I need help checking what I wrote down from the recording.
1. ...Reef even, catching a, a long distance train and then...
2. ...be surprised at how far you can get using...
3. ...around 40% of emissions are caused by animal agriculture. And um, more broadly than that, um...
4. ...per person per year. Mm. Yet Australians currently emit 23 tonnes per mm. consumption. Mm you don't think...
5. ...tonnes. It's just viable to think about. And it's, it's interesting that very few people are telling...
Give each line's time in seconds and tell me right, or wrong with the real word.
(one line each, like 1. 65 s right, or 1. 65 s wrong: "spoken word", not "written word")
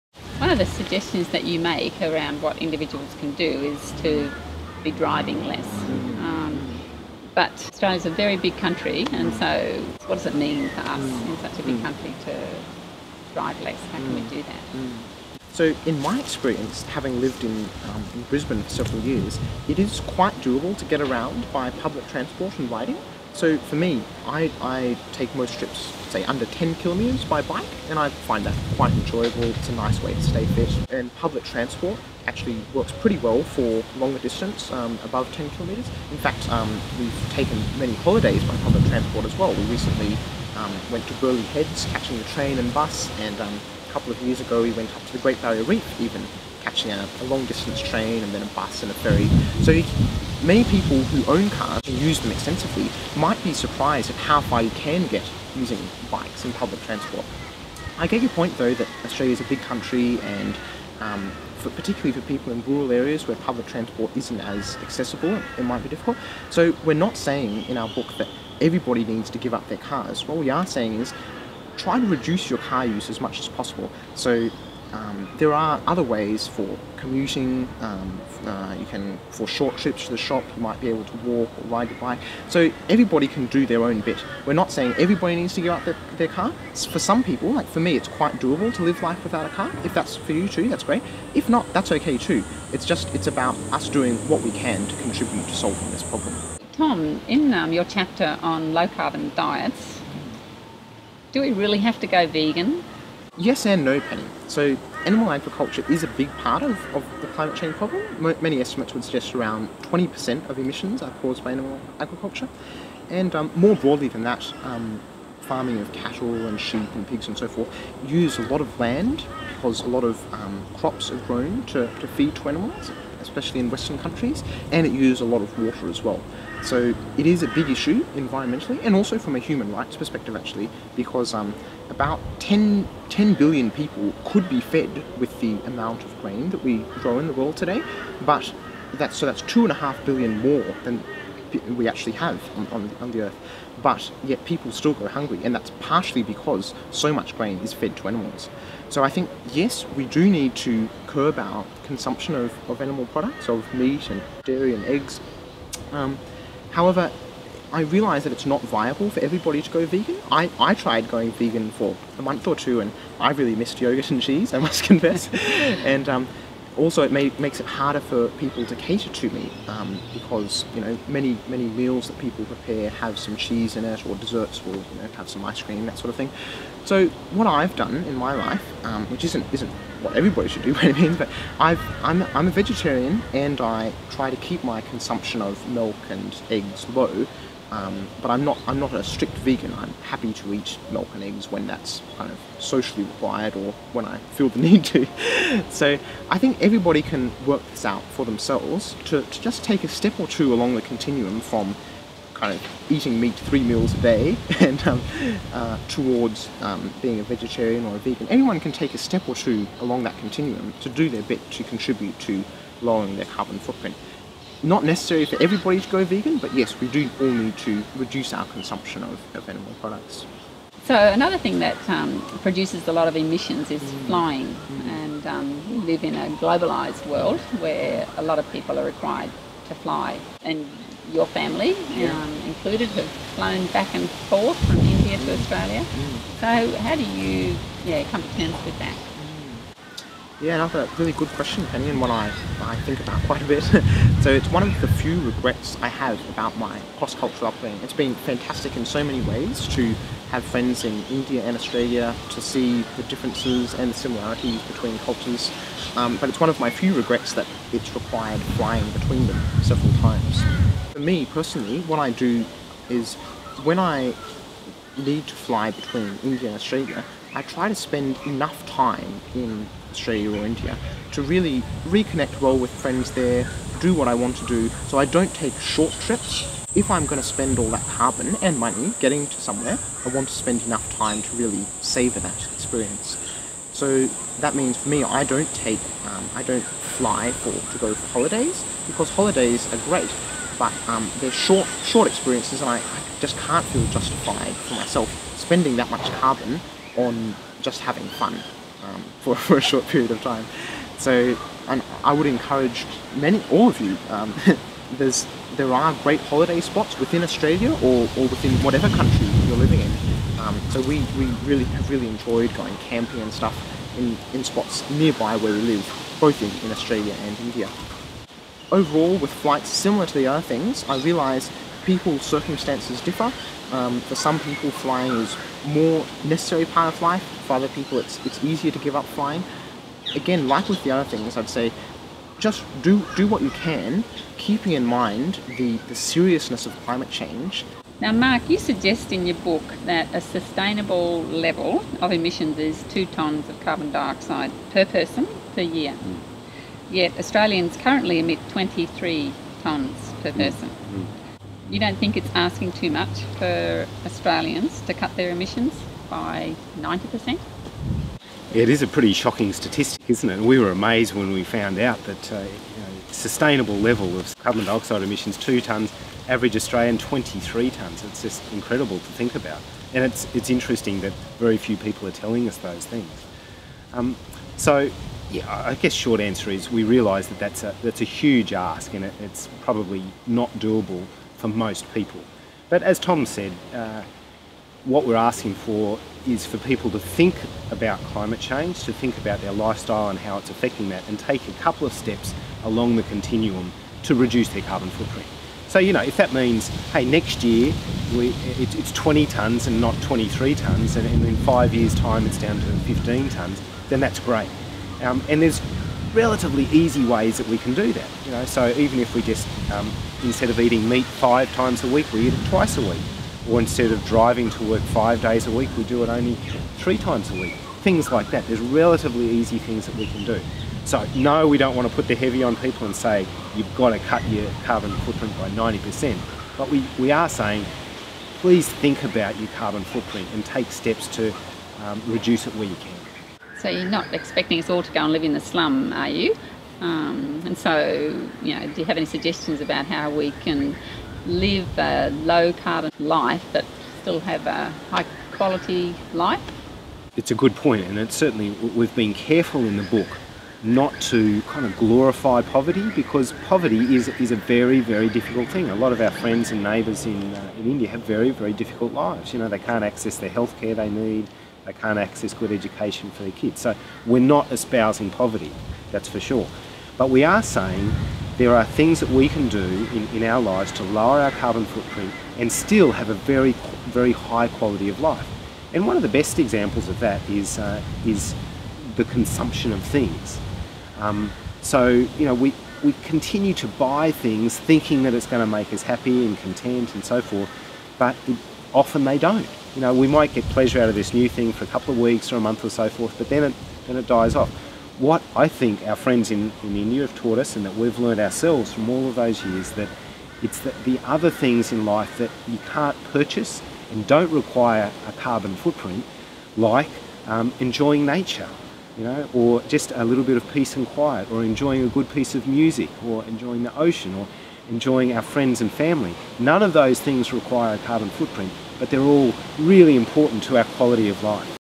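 1. 45 s right
2. 53 s right
3. 109 s wrong: "20", not "40"
4. 344 s wrong: "person", not "consumption"
5. 367 s wrong: "incredible", not "viable".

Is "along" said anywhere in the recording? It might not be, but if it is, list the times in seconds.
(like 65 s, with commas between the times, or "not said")
200 s, 209 s, 392 s.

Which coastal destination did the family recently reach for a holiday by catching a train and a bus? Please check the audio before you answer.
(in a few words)
Burleigh Heads.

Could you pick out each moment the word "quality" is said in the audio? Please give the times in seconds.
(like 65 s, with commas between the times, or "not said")
445 s, 474 s, 520 s.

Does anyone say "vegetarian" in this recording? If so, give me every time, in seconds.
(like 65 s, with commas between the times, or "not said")
182 s, 207 s.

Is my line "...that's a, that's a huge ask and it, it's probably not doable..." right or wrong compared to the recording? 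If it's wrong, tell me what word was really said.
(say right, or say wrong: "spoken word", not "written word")
right.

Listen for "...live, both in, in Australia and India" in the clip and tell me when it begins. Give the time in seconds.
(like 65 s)
315 s.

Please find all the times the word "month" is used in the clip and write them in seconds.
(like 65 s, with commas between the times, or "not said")
162 s, 492 s.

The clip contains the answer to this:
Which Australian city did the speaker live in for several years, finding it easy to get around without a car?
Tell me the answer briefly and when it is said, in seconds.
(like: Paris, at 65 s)
Brisbane, at 18 s.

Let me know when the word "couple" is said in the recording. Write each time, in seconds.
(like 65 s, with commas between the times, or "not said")
43 s, 391 s, 491 s.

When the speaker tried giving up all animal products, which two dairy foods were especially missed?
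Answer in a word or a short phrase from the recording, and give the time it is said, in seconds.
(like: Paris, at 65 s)
yogurt and cheese, at 163 s.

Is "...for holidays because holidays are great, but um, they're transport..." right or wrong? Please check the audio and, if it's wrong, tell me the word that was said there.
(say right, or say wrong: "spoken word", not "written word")
wrong: "short", not "transport".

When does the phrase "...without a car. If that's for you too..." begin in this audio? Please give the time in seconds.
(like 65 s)
89 s.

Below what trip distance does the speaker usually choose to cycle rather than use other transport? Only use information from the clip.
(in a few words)
10 kilometers.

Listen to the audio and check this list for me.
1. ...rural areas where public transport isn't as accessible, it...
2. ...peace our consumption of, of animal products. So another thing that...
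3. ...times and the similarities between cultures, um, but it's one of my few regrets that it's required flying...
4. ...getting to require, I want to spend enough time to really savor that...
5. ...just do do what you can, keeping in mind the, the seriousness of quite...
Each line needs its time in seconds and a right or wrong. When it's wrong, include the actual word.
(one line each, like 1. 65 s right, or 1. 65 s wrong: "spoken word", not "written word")
1. 62 s right
2. 217 s wrong: "reduce", not "peace"
3. 253 s wrong: "differences", not "times"
4. 279 s wrong: "somewhere", not "require"
5. 332 s wrong: "climate", not "quite".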